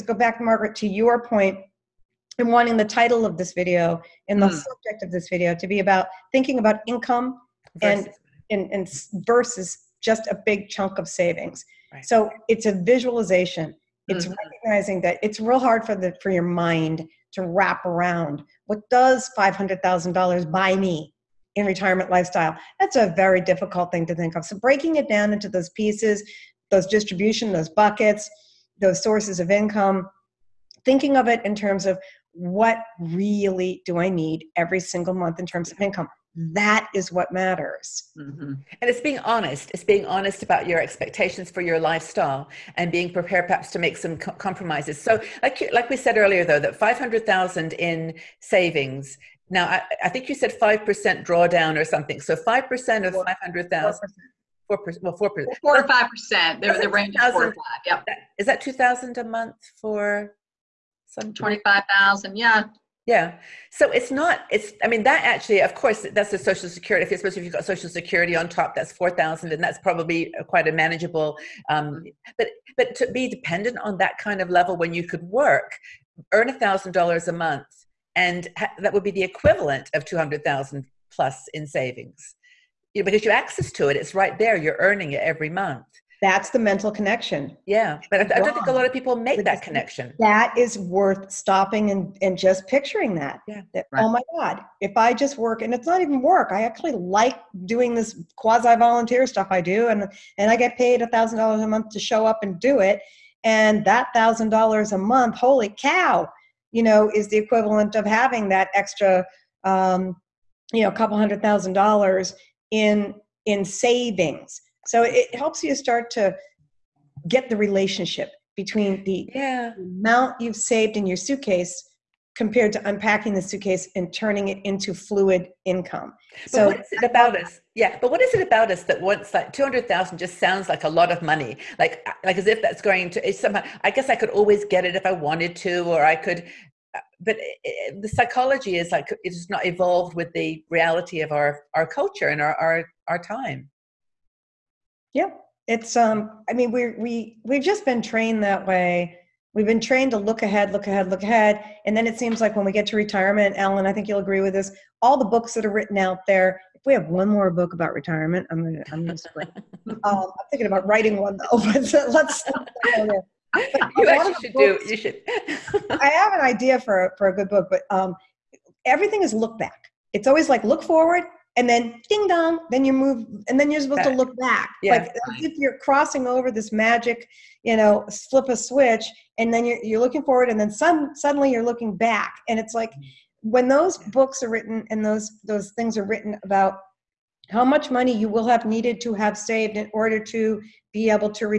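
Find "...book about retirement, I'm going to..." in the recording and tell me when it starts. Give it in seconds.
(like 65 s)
157 s.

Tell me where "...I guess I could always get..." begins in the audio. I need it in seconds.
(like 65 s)
133 s.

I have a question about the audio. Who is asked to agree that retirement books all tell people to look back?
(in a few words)
Ellen.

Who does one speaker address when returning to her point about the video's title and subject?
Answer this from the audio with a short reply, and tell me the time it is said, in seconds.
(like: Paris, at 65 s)
Margaret, at 0 s.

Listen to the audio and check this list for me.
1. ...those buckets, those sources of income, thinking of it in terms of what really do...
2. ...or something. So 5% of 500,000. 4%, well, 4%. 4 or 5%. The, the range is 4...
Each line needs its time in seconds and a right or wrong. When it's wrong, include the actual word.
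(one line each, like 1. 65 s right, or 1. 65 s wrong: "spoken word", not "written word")
1. 27 s right
2. 51 s right.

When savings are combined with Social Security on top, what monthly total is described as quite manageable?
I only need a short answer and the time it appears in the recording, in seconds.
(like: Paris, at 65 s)
4,000, at 68 s.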